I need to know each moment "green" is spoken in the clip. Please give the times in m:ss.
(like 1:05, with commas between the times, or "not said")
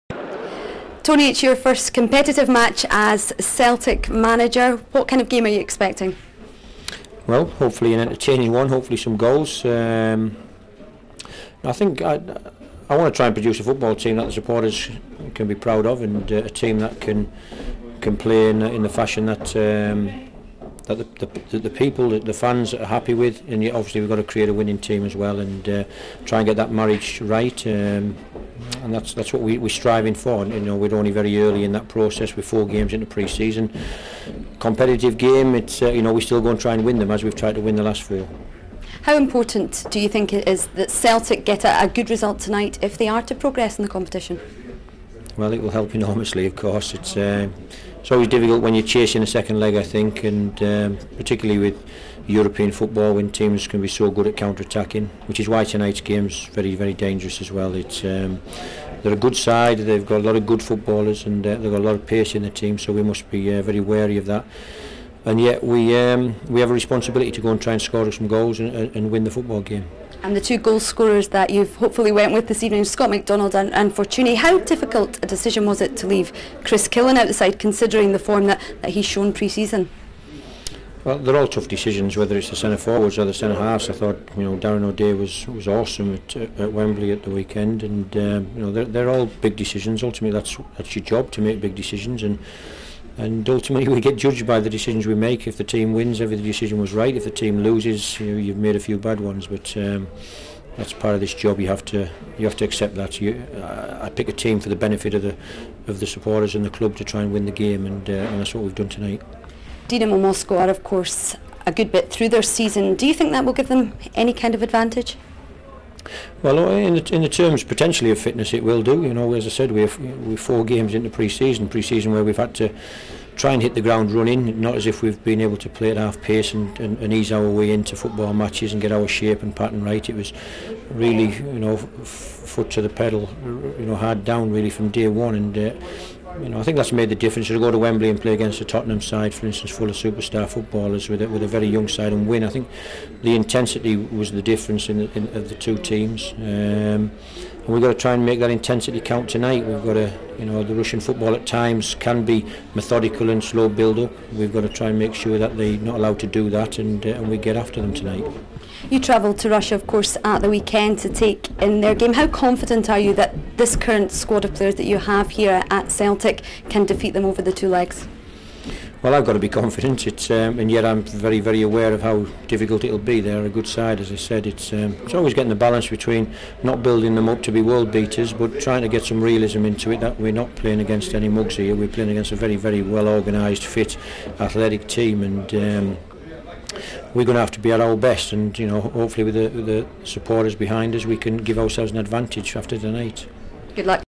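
not said.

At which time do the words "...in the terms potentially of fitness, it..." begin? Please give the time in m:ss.
1:57.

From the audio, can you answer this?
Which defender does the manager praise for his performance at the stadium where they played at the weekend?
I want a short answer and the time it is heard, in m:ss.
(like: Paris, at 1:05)
Darren O'Dea, at 1:24.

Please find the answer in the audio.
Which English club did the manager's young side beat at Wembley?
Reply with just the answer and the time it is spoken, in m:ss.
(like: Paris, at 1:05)
Tottenham, at 2:18.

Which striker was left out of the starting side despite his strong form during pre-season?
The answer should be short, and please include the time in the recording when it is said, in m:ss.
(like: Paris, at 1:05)
Chris Killen, at 1:16.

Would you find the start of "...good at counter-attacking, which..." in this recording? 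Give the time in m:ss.
0:54.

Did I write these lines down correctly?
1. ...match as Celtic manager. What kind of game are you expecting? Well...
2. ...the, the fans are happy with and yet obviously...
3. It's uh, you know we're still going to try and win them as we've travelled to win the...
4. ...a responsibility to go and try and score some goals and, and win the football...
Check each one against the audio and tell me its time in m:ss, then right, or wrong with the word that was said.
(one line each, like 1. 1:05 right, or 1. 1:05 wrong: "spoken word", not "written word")
1. 0:02 right
2. 0:22 right
3. 0:35 wrong: "tried", not "travelled"
4. 1:06 right.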